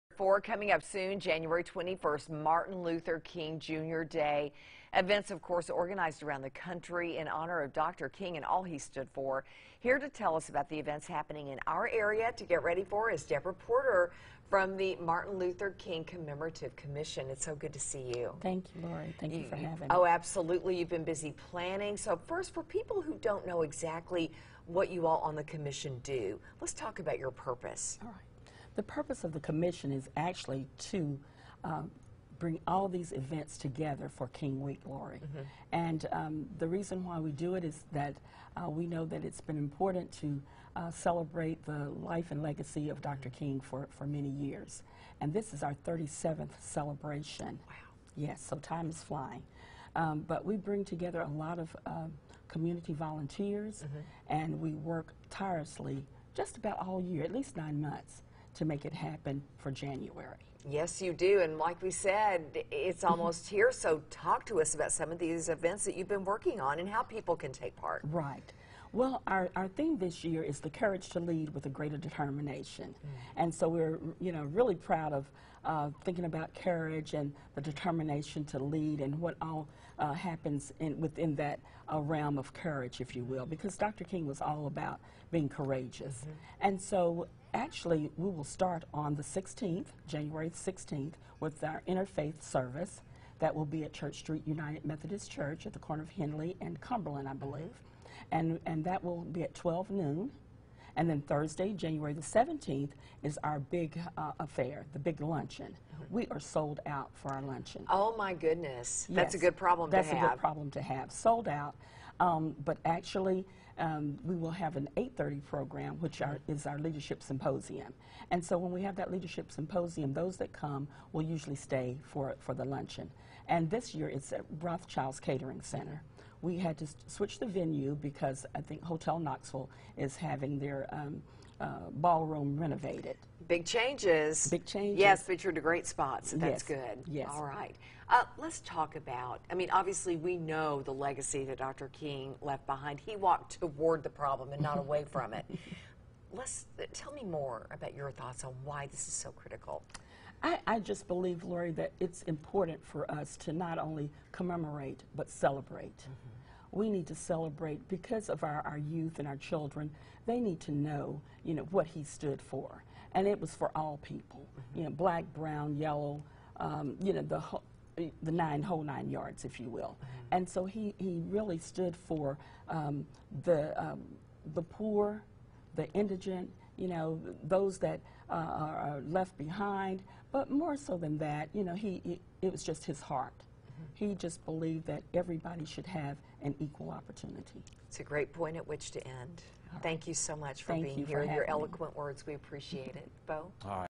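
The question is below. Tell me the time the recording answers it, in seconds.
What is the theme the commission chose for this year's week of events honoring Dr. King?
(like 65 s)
70 s.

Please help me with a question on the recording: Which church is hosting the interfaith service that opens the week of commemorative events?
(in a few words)
Church Street United Methodist Church.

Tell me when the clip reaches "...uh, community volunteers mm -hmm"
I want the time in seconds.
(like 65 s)
51 s.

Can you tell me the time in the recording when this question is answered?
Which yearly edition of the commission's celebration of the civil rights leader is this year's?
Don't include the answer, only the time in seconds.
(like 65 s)
45 s.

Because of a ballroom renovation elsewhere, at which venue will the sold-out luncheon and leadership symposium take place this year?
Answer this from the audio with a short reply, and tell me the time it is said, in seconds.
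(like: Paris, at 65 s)
Rothchild's Catering Center, at 124 s.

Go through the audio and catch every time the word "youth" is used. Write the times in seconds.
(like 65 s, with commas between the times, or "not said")
158 s.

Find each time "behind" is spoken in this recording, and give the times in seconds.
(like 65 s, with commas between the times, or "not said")
142 s, 179 s.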